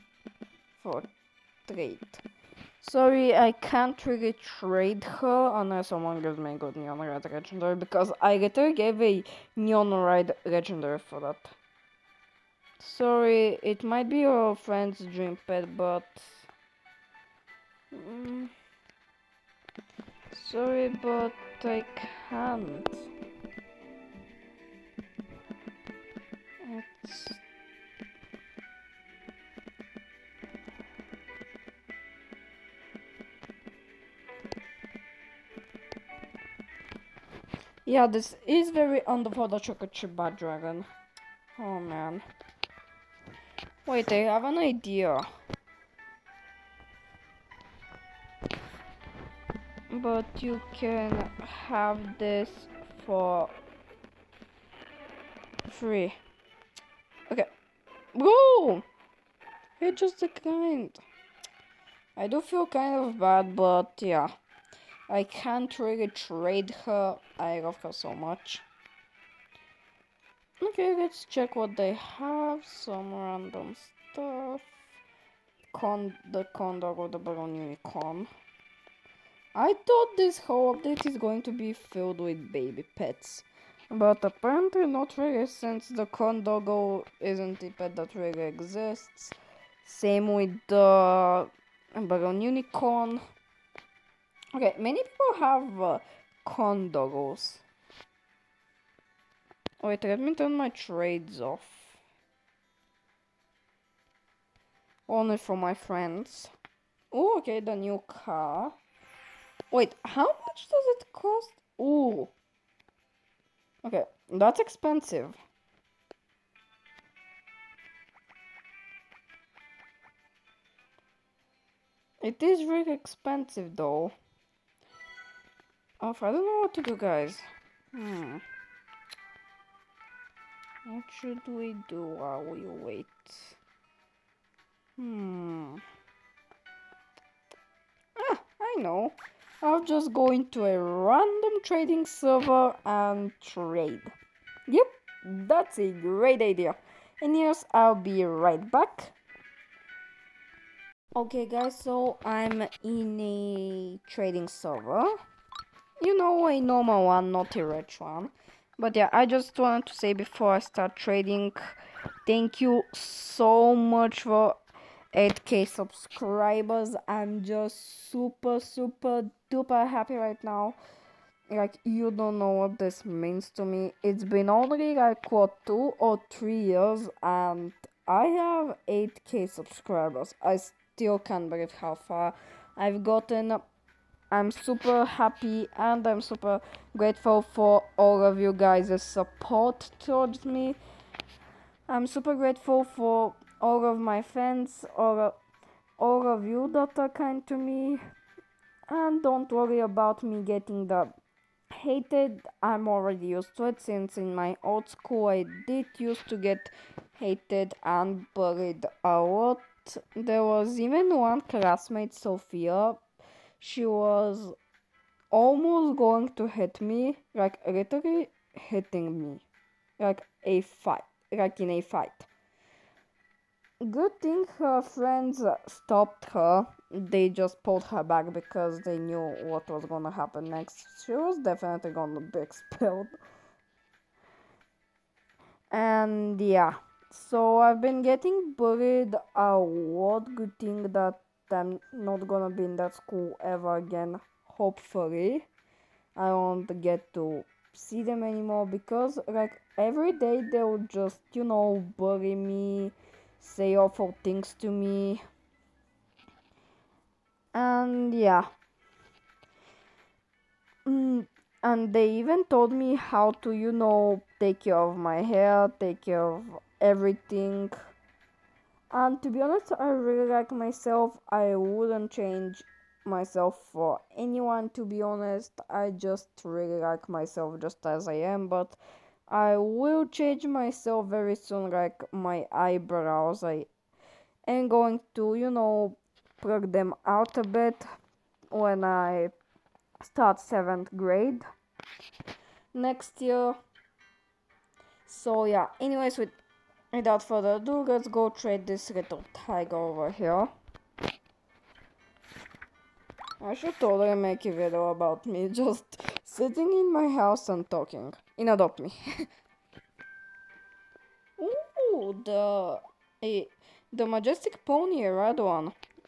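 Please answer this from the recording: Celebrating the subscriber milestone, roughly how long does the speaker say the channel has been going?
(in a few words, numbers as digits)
2 or 3 years.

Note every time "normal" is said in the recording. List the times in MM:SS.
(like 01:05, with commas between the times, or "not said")
02:36.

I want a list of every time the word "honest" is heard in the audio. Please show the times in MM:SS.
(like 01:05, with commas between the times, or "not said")
04:29, 04:35.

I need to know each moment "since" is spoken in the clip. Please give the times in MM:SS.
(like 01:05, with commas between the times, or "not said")
01:25, 03:23.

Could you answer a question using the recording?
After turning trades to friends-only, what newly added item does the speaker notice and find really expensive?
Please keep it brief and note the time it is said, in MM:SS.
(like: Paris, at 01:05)
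the new car, at 01:47.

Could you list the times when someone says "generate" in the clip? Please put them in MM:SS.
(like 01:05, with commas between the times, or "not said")
not said.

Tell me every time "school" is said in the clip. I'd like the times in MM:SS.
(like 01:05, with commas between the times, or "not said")
03:24, 04:02.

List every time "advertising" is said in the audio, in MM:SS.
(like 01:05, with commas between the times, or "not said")
not said.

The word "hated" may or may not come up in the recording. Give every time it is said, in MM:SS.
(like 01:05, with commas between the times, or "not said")
03:21, 03:27.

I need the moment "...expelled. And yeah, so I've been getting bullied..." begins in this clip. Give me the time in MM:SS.
03:52.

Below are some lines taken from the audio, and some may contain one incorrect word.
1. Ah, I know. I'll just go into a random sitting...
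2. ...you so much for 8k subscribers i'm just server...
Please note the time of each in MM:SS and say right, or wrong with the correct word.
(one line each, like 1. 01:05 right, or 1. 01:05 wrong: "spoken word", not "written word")
1. 02:18 wrong: "trading", not "sitting"
2. 02:42 wrong: "super", not "server".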